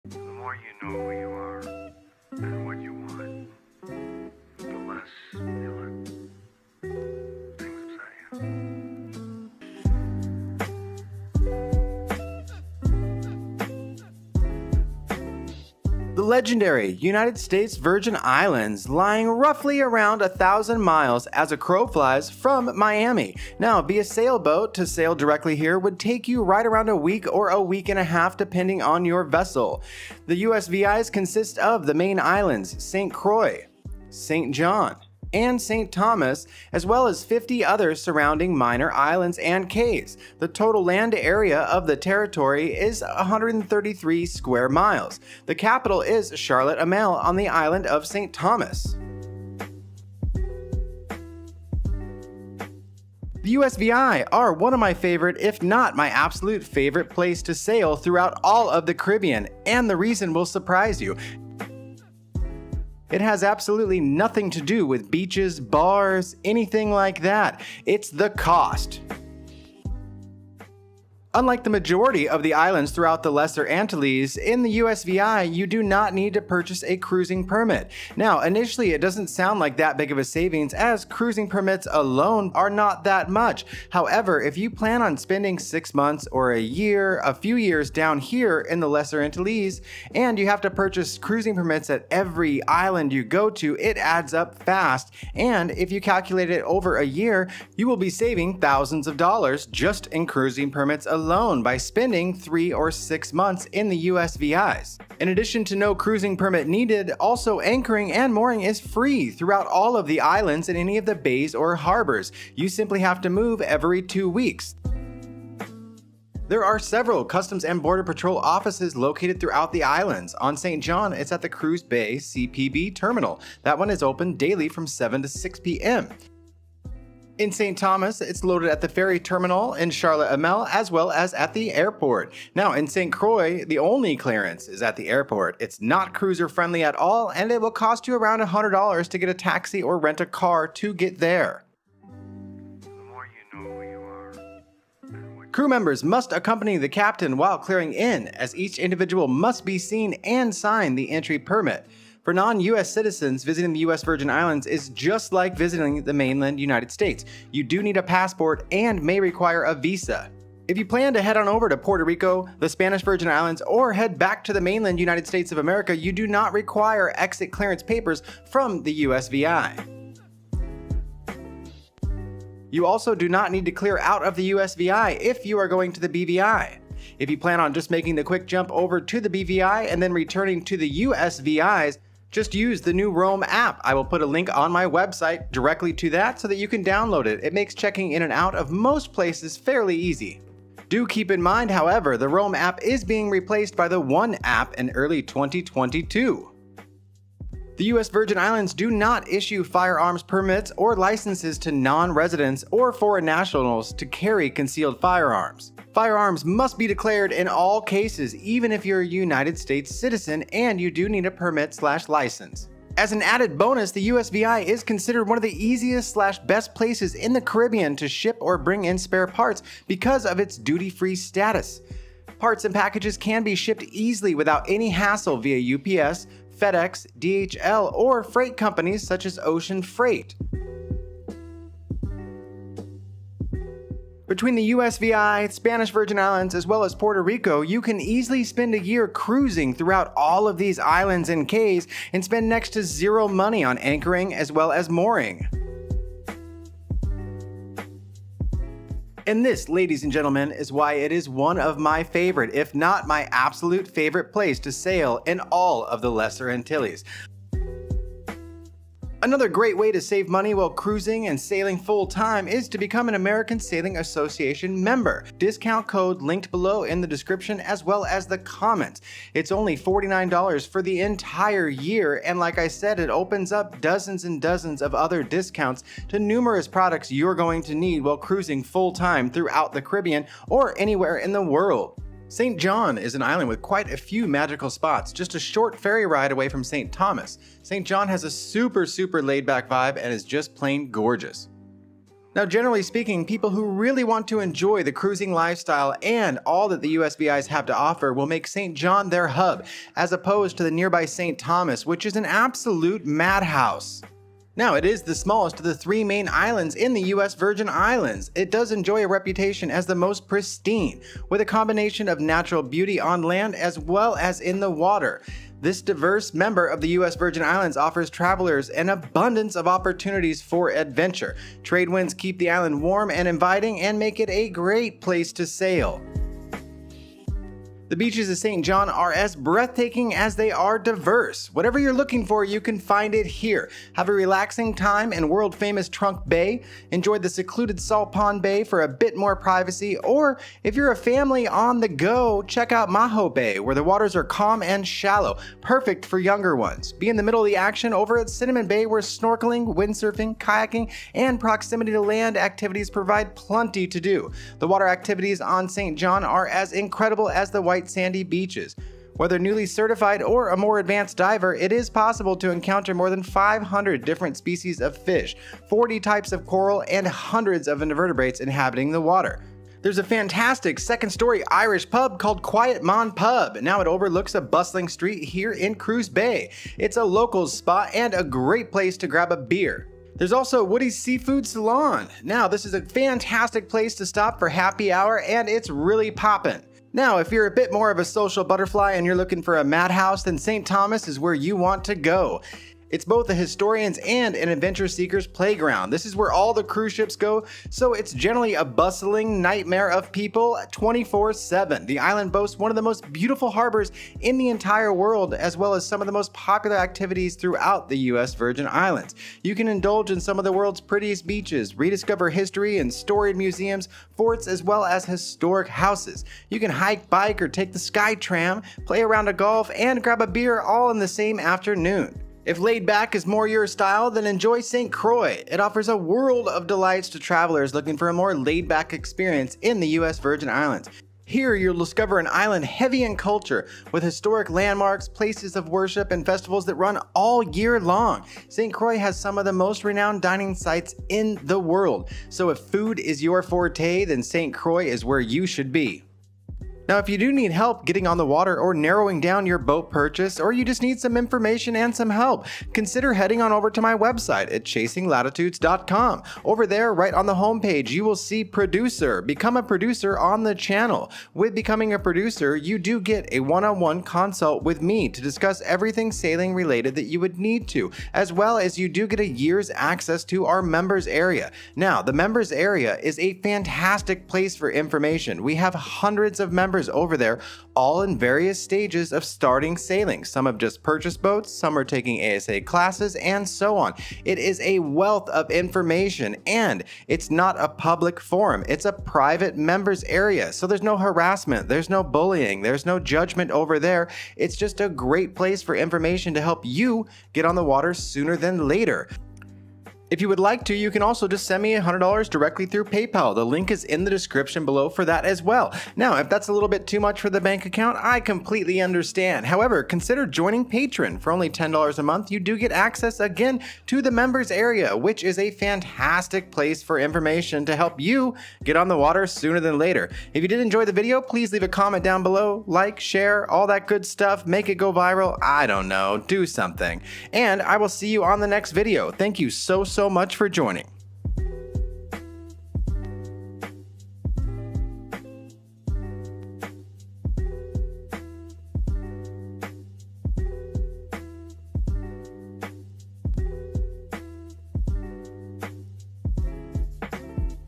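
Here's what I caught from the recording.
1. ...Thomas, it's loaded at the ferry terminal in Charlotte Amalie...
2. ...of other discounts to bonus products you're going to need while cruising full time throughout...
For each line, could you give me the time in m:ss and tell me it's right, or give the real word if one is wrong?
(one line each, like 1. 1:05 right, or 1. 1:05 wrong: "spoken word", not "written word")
1. 2:07 right
2. 4:34 wrong: "numerous", not "bonus".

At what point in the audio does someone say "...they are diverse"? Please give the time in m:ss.
5:30.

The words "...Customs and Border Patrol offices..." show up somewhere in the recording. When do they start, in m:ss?
1:57.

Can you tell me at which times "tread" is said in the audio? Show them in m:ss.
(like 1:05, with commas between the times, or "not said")
not said.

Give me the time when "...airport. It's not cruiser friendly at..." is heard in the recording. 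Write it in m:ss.
2:15.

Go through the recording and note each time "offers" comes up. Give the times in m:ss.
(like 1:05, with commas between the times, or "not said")
4:57, 5:17, 7:05.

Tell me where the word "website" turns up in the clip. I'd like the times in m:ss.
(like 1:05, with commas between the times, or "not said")
3:04, 7:33.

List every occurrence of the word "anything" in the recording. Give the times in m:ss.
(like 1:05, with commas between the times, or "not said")
1:06.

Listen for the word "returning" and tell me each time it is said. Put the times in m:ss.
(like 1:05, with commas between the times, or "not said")
3:00.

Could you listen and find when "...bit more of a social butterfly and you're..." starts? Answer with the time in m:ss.
6:27.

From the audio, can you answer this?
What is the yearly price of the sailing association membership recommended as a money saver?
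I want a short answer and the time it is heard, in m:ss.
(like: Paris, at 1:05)
$49, at 4:29.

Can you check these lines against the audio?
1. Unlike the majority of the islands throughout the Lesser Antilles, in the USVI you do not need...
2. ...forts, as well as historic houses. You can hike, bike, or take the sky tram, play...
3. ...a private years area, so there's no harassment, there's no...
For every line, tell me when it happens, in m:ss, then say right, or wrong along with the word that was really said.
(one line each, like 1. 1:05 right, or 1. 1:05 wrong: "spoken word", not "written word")
1. 1:11 right
2. 6:54 right
3. 8:08 wrong: "members", not "years".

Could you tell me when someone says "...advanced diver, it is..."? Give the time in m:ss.
6:00.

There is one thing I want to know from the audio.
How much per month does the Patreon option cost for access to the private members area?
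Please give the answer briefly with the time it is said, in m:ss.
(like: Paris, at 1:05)
$10, at 8:31.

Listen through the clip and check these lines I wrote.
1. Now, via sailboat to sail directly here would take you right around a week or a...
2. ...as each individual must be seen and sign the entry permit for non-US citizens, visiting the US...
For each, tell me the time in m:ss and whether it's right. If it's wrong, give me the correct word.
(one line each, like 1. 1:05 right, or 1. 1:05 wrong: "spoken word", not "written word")
1. 0:23 right
2. 2:28 right.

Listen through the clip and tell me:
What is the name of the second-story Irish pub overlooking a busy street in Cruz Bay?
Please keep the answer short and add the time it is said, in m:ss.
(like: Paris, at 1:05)
Quiet Mon Pub, at 6:12.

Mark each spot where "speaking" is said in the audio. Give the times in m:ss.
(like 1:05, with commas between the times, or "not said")
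4:52.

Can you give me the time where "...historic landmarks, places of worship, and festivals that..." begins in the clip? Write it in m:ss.
7:14.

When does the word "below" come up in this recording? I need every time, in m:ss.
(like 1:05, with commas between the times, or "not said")
4:26, 8:24, 8:42.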